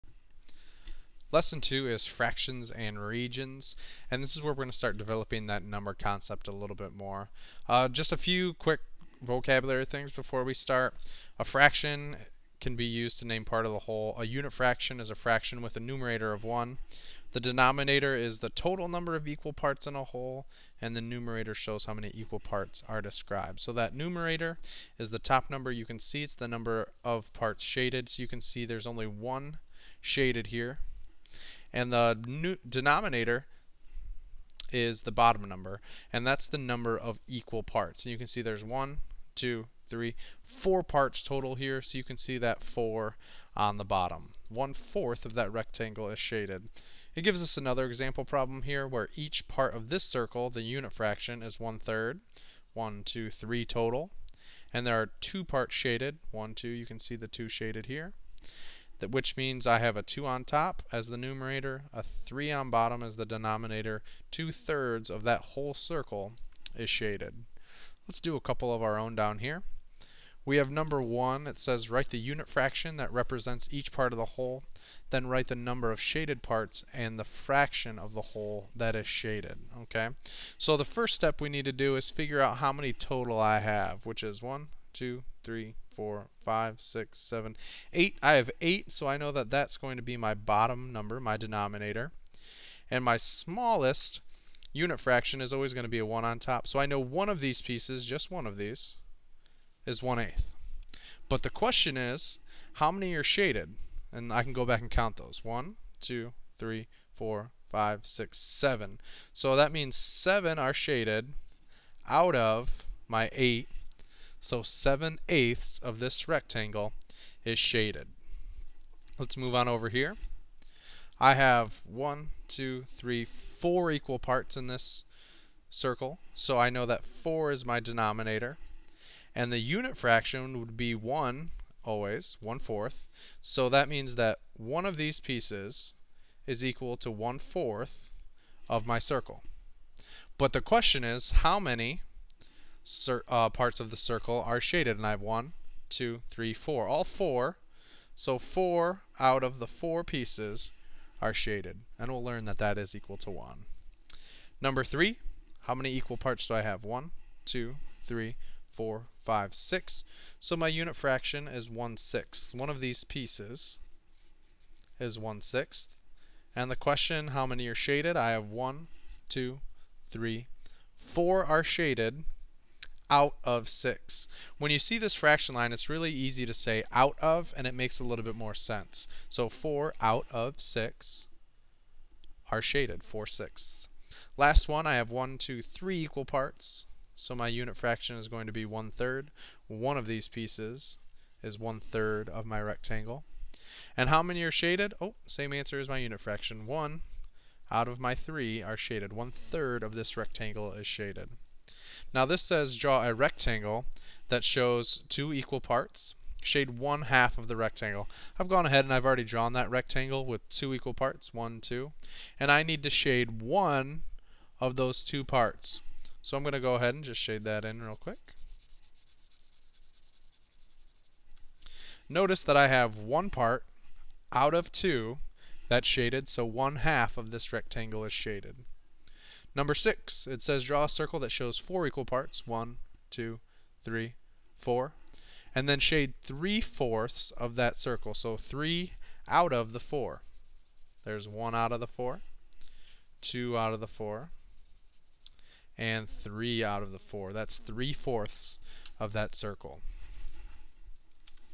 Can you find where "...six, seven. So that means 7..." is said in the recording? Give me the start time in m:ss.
1:48.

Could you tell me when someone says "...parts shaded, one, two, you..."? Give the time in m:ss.
0:55.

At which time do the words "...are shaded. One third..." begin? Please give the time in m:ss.
3:18.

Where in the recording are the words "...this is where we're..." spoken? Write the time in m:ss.
0:04.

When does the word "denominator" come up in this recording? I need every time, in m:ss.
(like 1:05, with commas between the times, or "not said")
0:17, 0:32, 1:03, 1:31, 2:07.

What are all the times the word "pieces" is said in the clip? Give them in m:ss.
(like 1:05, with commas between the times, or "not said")
1:37, 2:15, 2:30, 2:43, 3:10.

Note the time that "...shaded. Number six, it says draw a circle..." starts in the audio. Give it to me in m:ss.
3:48.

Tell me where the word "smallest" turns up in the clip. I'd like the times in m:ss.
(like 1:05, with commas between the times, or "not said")
1:33.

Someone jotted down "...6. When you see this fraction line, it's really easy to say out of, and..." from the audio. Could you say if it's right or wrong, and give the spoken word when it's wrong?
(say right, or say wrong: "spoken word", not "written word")
right.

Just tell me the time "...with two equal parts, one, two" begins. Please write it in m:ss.
3:30.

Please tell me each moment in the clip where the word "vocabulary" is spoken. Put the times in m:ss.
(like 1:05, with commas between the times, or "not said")
0:09.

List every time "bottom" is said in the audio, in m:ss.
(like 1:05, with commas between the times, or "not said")
0:35, 0:43, 1:02, 1:30.